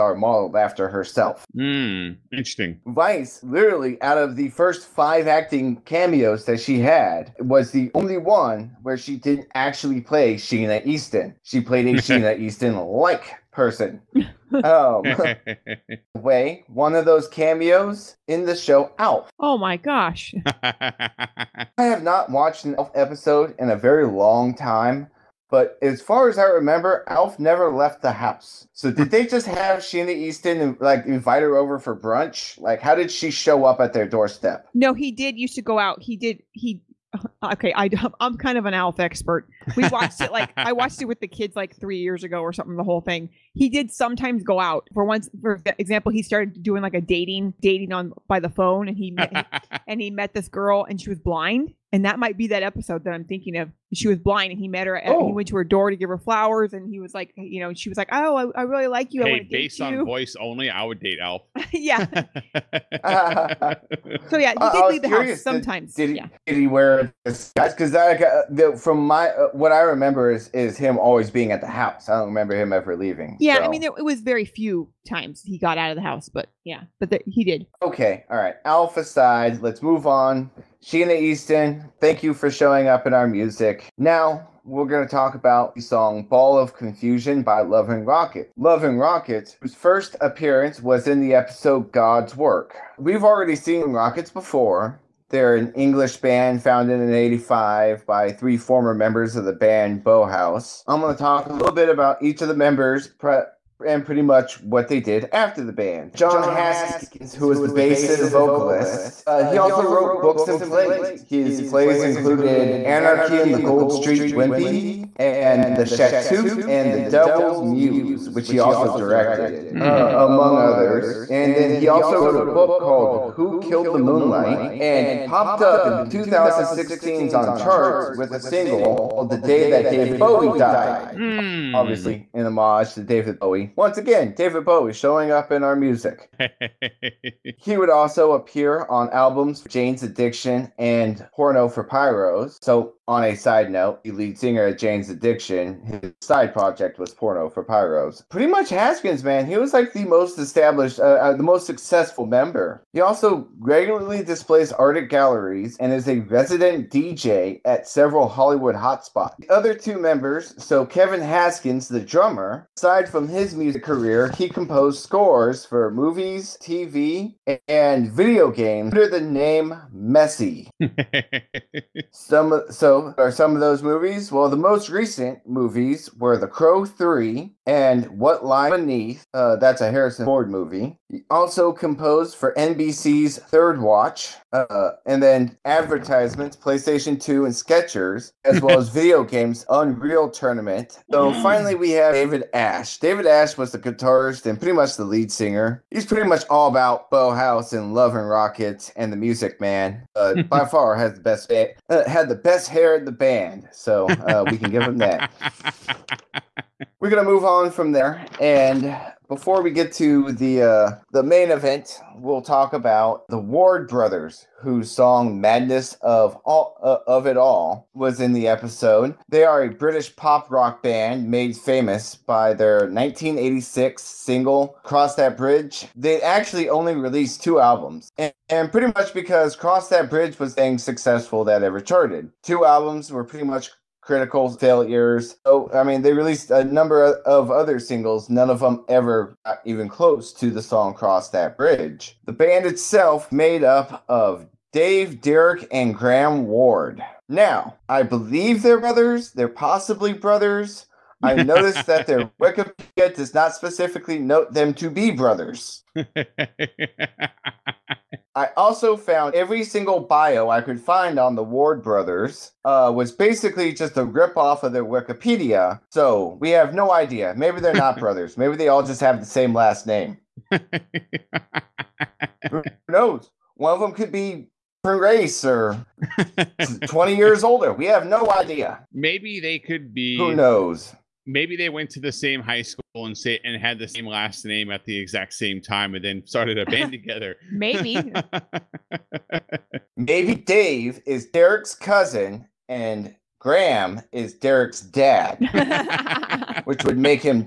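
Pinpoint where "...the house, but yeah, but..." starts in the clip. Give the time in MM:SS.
01:15.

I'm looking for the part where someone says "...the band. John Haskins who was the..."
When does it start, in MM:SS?
01:45.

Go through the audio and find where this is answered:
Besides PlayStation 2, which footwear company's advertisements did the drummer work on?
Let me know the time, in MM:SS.
03:07.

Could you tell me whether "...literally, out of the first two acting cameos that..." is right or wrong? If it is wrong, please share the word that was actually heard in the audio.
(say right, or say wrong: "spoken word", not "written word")
wrong: "five", not "two".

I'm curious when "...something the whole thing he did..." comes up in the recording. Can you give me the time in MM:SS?
00:42.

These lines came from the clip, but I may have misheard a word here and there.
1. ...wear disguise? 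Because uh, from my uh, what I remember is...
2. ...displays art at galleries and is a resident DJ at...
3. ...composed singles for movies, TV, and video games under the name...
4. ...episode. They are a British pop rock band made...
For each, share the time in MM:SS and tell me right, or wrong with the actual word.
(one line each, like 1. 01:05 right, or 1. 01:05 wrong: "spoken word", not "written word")
1. 01:06 right
2. 02:34 right
3. 02:44 wrong: "scores", not "singles"
4. 03:38 right.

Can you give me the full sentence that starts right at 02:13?
Once again, David Bowie showing up in our music.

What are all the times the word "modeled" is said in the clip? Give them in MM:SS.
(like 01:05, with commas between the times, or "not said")
00:00.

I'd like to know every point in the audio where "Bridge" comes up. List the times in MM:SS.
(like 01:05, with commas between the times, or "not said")
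03:45, 03:50, 04:01.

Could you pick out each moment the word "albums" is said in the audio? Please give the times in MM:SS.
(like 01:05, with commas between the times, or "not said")
02:19, 03:47, 03:52.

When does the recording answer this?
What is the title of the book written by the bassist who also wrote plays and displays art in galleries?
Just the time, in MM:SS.
02:03.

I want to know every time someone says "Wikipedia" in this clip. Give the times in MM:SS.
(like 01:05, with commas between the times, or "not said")
04:12, 04:24.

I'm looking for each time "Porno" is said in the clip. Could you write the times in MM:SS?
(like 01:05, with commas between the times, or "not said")
02:21, 02:27.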